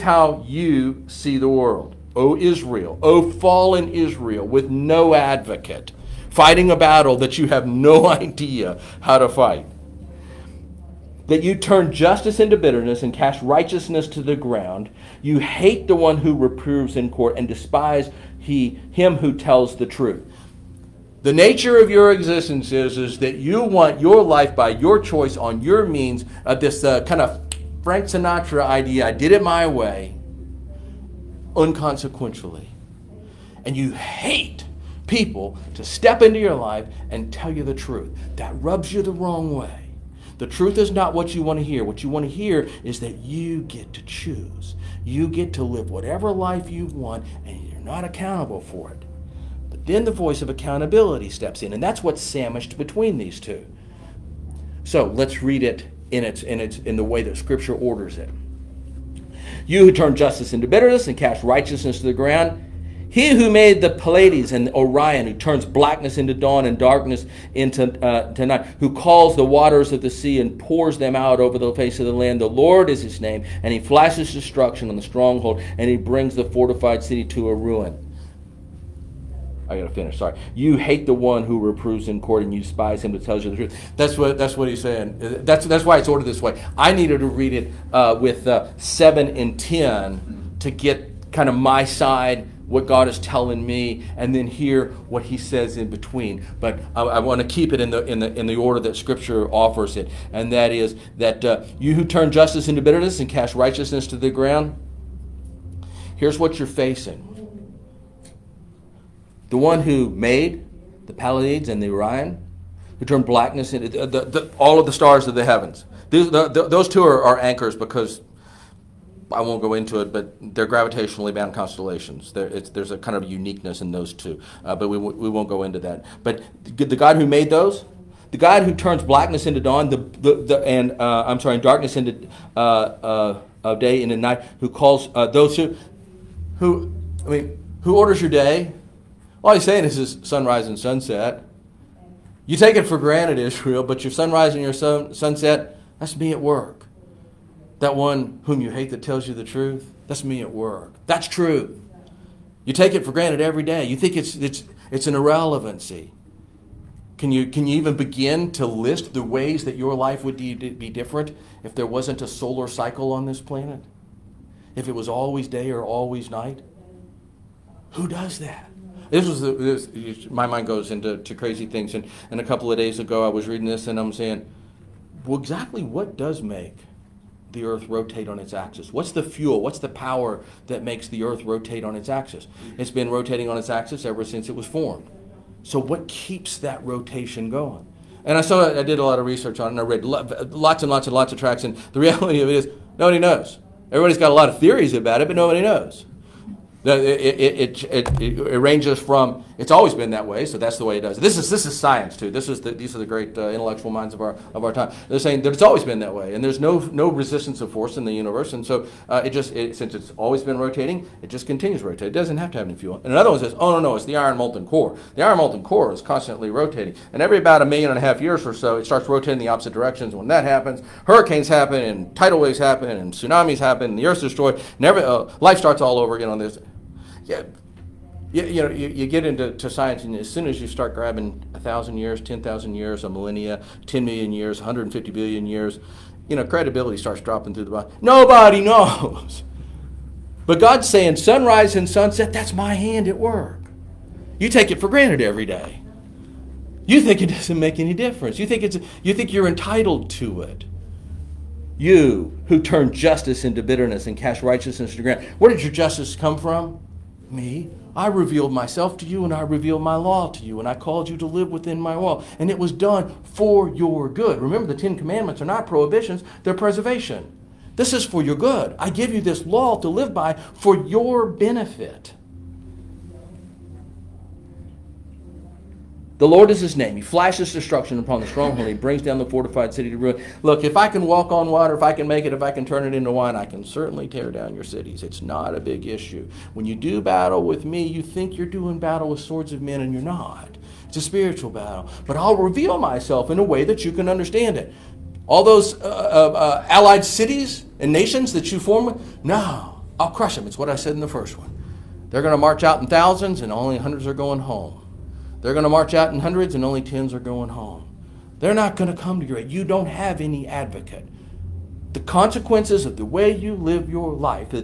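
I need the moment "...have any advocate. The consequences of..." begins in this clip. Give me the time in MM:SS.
05:09.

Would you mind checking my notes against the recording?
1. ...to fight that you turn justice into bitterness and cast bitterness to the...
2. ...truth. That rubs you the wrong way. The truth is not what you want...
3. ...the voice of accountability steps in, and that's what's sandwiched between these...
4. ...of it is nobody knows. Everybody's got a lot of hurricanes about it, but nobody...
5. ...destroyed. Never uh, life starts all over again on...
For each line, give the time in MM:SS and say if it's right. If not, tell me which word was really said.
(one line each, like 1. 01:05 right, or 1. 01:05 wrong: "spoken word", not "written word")
1. 00:09 wrong: "righteousness", not "bitterness"
2. 00:37 right
3. 00:50 right
4. 03:12 wrong: "theories", not "hurricanes"
5. 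03:44 right.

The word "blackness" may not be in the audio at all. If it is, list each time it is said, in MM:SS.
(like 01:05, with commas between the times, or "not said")
01:05, 01:53, 02:09.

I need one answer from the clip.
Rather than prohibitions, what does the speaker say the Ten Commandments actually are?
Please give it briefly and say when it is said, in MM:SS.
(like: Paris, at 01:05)
preservation, at 04:26.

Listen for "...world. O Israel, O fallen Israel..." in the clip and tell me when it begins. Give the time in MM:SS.
00:01.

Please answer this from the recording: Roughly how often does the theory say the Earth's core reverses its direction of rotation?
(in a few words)
about 1.5 million years.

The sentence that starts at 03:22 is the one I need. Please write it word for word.
This is the, these are the great uh, intellectual minds of our of our time.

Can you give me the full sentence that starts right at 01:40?
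And that is that uh, you who turn justice into bitterness and cast righteousness to the ground, here's what you're facing.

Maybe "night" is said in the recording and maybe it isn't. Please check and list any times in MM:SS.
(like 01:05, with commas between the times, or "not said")
01:08, 02:14, 02:46.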